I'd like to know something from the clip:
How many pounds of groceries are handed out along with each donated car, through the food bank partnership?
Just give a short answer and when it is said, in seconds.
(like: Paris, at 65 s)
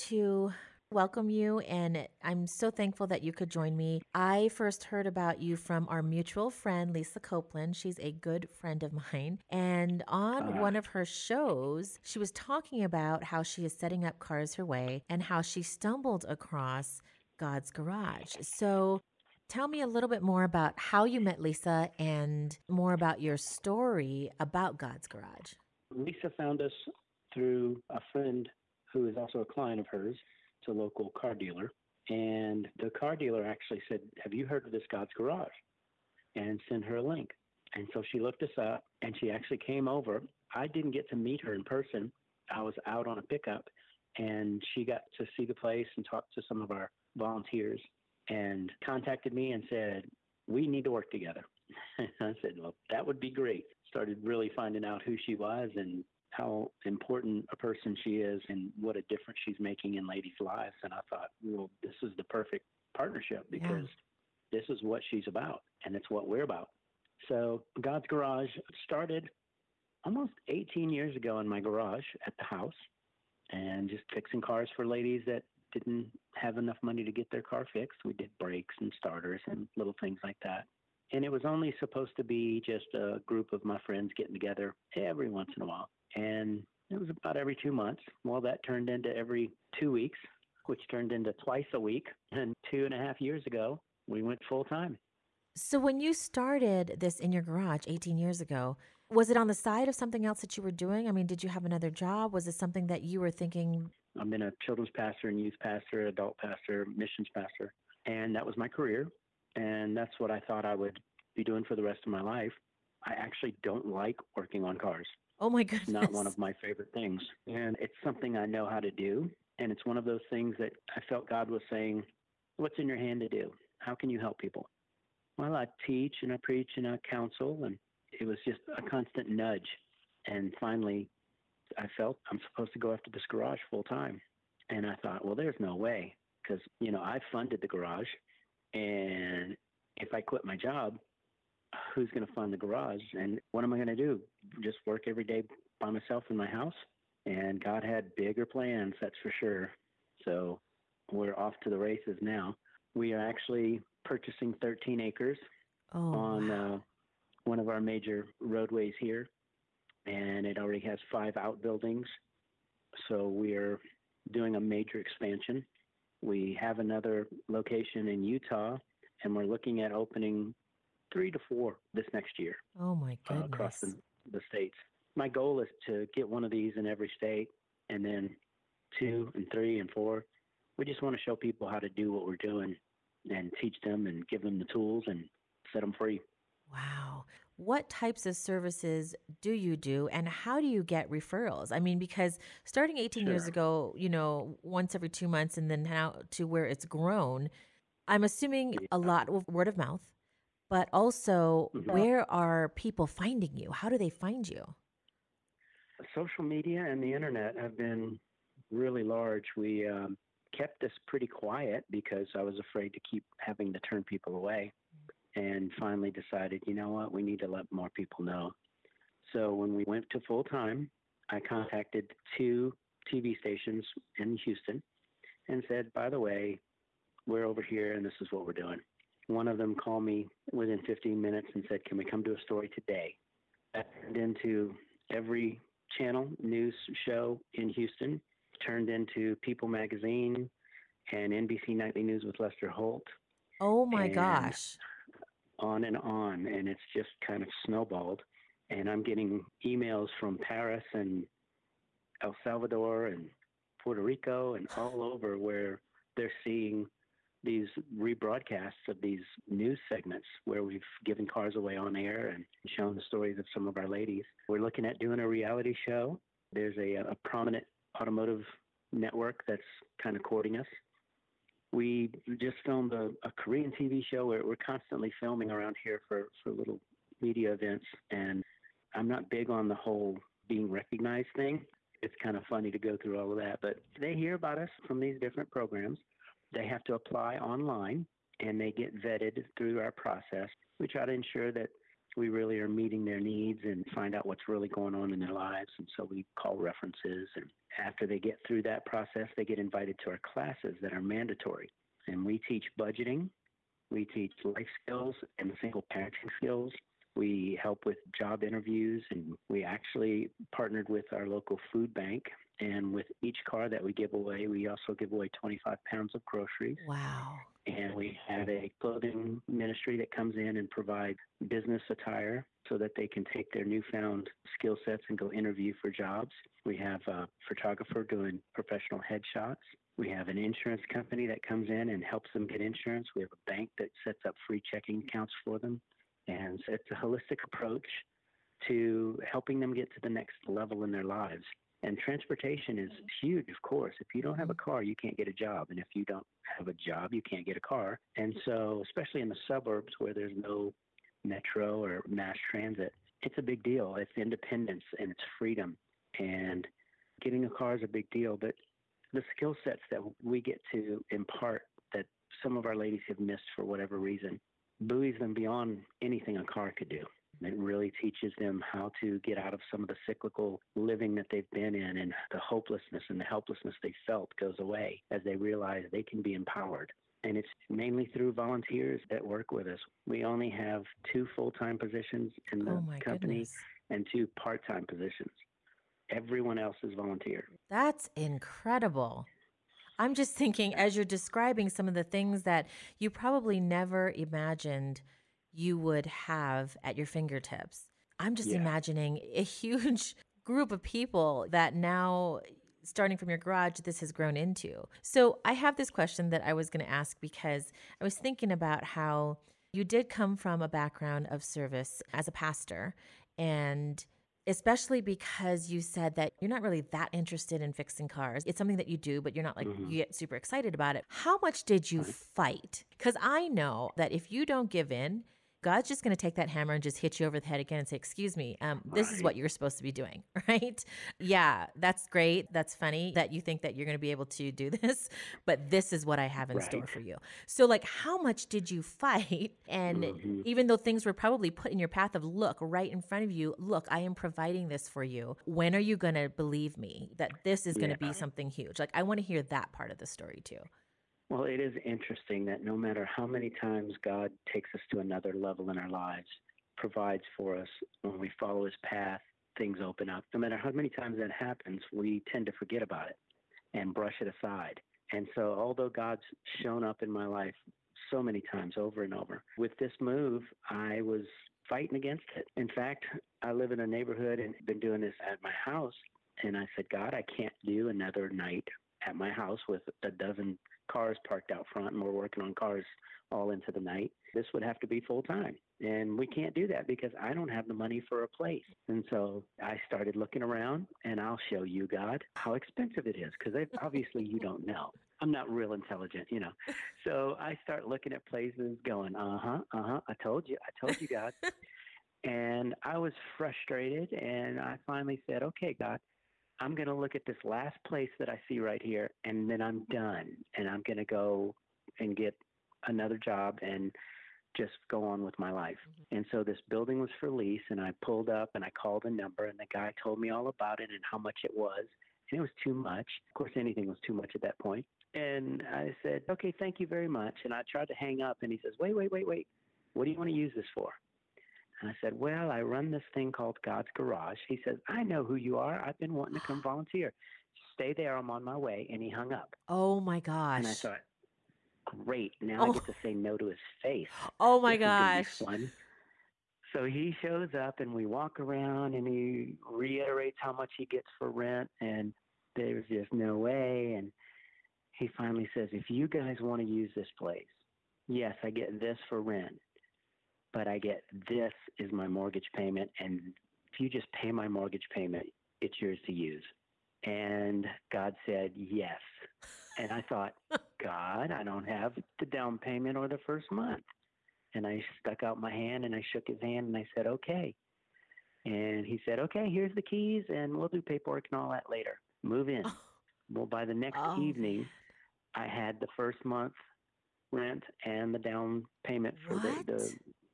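25, at 315 s.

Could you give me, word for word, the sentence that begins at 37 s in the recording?
And so she looked us up, and she actually came over.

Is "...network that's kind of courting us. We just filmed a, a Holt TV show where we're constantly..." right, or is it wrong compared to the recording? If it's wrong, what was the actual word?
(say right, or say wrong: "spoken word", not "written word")
wrong: "Korean", not "Holt".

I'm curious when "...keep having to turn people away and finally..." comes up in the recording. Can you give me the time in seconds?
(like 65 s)
213 s.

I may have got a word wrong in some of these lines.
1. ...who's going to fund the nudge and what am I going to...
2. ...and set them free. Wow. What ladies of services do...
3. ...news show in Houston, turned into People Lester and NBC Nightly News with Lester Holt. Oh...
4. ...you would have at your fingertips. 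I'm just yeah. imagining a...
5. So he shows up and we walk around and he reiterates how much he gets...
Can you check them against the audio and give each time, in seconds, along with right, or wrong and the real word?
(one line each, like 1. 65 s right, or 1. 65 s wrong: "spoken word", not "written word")
1. 141 s wrong: "garage", not "nudge"
2. 185 s wrong: "types", not "ladies"
3. 236 s wrong: "Magazine", not "Lester"
4. 395 s right
5. 546 s right.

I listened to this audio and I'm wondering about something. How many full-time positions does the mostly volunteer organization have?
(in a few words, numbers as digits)
2.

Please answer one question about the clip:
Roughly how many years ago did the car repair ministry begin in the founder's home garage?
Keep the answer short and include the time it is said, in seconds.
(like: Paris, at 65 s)
18, at 70 s.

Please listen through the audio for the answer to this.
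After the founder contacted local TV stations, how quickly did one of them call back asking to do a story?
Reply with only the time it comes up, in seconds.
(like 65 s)
230 s.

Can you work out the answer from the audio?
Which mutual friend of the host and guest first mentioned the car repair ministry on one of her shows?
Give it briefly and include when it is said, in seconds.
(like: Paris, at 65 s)
Lisa Copeland, at 6 s.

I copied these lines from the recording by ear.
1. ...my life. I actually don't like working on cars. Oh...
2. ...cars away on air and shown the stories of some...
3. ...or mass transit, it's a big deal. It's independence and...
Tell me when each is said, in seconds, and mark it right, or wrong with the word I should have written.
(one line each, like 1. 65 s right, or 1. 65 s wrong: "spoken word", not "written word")
1. 112 s right
2. 261 s right
3. 351 s right.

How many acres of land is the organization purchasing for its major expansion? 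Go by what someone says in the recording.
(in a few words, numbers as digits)
13.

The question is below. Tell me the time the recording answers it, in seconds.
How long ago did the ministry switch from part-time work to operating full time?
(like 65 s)
92 s.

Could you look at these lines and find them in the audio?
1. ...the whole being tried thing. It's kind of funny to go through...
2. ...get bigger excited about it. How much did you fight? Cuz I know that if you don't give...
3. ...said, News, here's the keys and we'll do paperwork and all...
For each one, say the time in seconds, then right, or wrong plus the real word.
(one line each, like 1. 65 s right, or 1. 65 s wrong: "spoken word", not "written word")
1. 279 s wrong: "recognized", not "tried"
2. 419 s wrong: "super", not "bigger"
3. 579 s wrong: "Okay", not "News".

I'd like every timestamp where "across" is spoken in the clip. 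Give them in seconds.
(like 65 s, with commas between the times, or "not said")
16 s, 173 s.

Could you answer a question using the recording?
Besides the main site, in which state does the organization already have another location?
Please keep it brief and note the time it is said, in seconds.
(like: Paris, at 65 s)
Utah, at 168 s.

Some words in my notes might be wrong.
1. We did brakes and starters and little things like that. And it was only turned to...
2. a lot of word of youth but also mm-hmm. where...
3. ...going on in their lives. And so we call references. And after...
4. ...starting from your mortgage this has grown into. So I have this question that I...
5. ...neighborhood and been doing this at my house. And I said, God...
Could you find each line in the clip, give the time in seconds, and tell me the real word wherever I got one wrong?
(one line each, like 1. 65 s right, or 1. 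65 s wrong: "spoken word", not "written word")
1. 78 s wrong: "supposed", not "turned"
2. 198 s wrong: "mouth", not "youth"
3. 294 s right
4. 402 s wrong: "garage", not "mortgage"
5. 473 s right.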